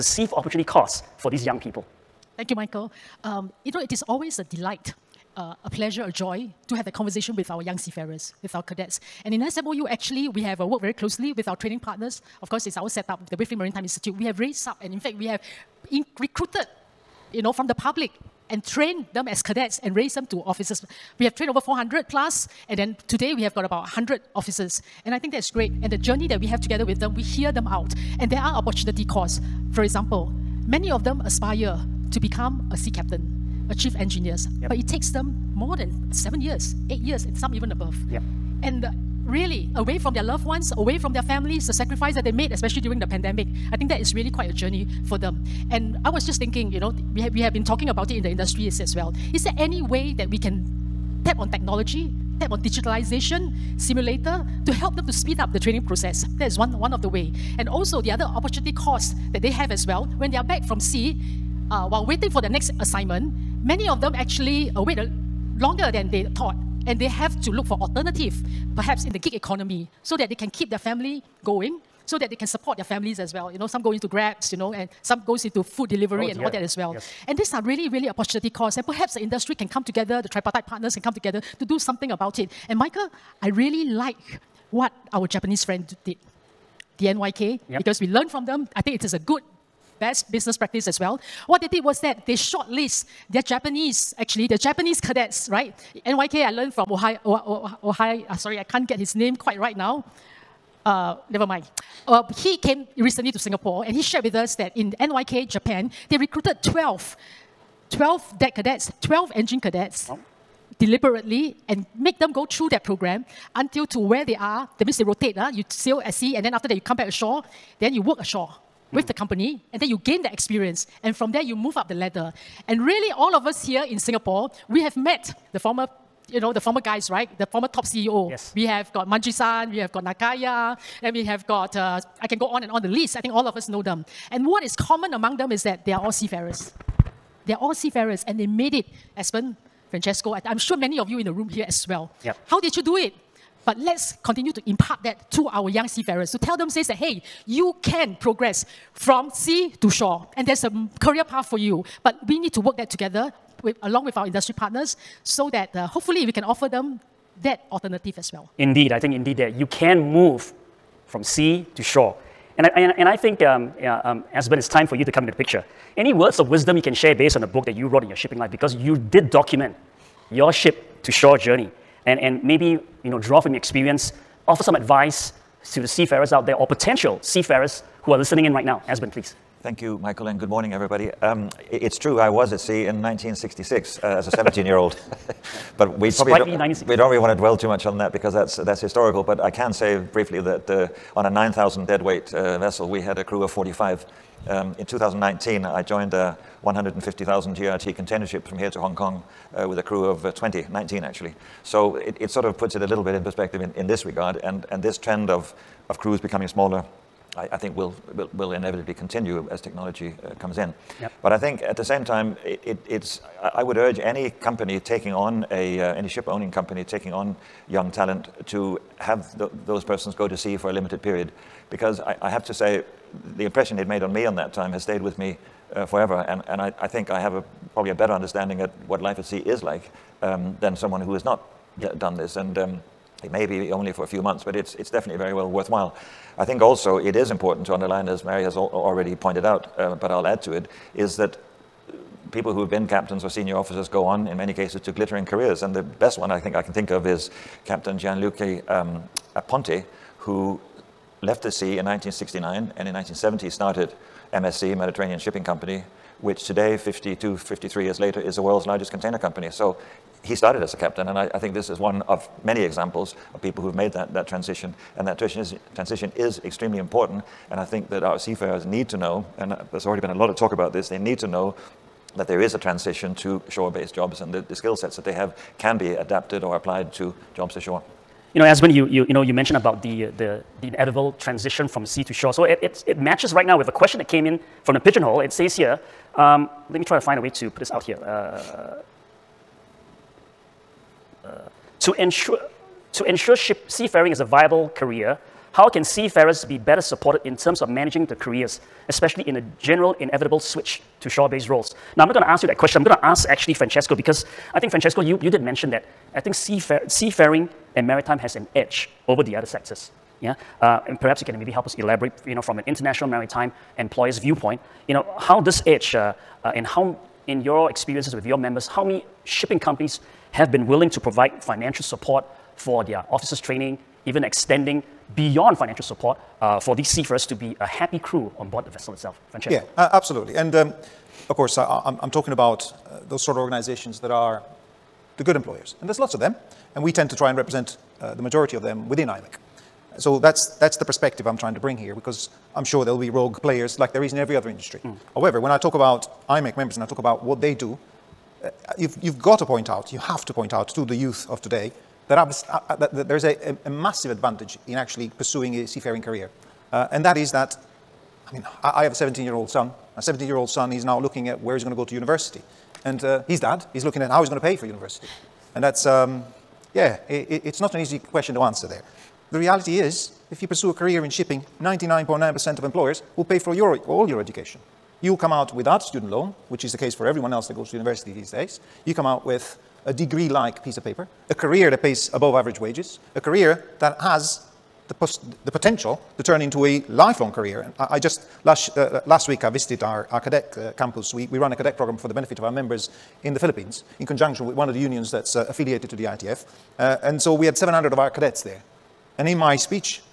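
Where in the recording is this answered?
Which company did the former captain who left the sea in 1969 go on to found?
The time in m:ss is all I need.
4:14.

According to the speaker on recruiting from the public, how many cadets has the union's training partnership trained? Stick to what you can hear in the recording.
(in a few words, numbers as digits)
400 plus.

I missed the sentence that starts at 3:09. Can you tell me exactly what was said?
But I can say briefly that uh, on a 9,000 deadweight uh, vessel, we had a crew of 45.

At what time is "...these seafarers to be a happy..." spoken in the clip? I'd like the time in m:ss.
5:26.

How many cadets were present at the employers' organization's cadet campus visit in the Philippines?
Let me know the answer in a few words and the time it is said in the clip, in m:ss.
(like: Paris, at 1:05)
700, at 6:37.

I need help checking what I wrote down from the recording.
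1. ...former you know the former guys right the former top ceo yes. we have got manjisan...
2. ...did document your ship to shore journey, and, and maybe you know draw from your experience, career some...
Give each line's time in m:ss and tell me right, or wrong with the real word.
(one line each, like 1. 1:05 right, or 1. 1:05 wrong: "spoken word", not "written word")
1. 2:05 right
2. 2:48 wrong: "offer", not "career".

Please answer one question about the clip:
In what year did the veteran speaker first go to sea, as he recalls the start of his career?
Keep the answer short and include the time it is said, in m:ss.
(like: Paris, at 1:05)
1966, at 3:03.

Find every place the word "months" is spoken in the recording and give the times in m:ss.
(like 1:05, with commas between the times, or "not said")
3:54.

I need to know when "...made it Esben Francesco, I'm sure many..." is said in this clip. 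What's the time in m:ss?
2:18.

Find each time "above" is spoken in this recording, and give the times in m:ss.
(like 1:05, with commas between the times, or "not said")
0:37, 6:22.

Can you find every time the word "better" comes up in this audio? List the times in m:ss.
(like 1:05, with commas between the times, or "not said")
3:47, 4:56.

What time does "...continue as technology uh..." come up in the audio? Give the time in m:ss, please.
3:28.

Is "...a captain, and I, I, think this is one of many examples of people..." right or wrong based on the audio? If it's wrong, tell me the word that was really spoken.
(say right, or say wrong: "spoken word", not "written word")
right.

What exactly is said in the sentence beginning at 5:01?
Now, I'm not going to ask you that question.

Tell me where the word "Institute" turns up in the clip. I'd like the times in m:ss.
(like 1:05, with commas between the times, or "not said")
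0:13.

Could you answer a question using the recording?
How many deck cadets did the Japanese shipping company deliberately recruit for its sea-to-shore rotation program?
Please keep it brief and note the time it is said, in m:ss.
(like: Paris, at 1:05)
12, at 1:46.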